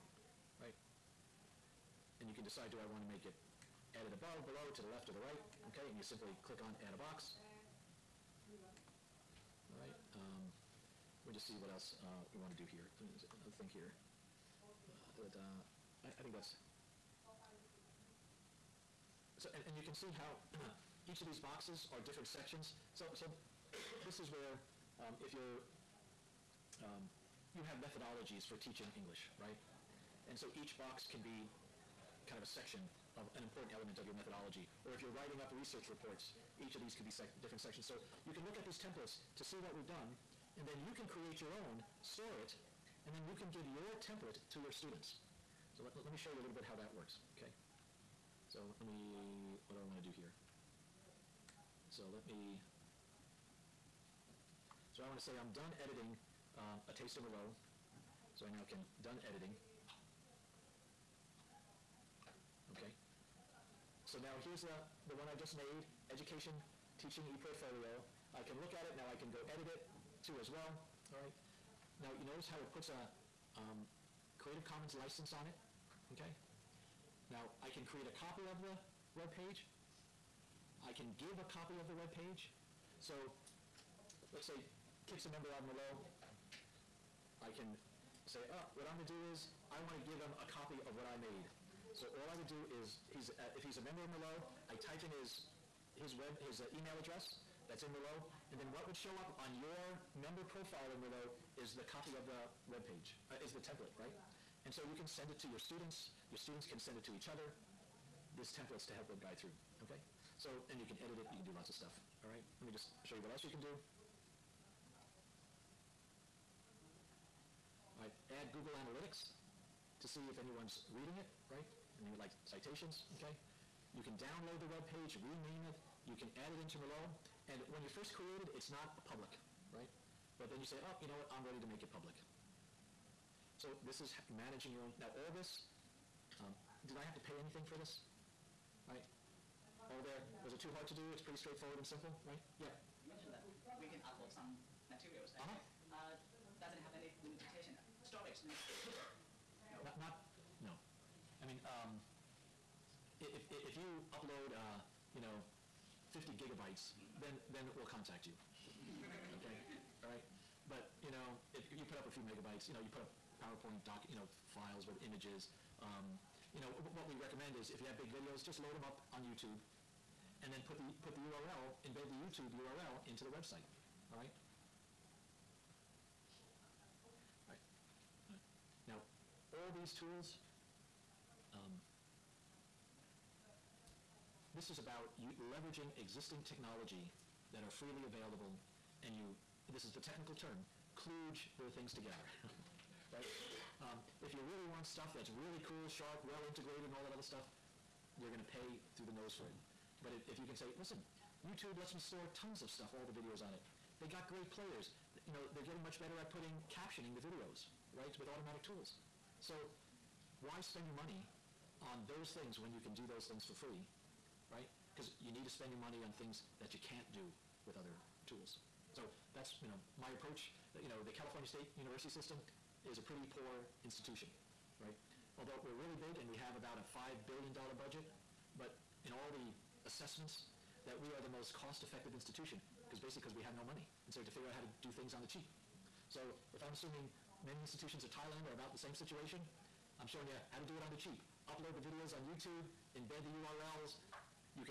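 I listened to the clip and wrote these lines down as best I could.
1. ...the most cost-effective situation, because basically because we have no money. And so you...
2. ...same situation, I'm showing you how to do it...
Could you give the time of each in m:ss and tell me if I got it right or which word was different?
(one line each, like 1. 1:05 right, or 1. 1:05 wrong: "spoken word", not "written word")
1. 3:51 wrong: "institution", not "situation"
2. 3:58 right.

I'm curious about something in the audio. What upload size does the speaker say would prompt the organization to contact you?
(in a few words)
50 gigabytes.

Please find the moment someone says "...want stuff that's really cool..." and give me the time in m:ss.
3:14.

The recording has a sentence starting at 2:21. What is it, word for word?
It's pretty straightforward and simple, right?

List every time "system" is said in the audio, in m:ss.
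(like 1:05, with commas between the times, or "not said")
3:42.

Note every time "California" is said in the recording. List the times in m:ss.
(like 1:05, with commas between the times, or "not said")
3:41.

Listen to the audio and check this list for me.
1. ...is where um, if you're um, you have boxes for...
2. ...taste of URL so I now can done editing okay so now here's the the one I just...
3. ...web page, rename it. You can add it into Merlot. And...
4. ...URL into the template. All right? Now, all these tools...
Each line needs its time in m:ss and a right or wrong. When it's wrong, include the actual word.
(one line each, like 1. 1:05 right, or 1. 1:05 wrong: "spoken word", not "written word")
1. 0:24 wrong: "methodologies", not "boxes"
2. 0:56 wrong: "Merlot", not "URL"
3. 2:04 right
4. 2:52 wrong: "website", not "template".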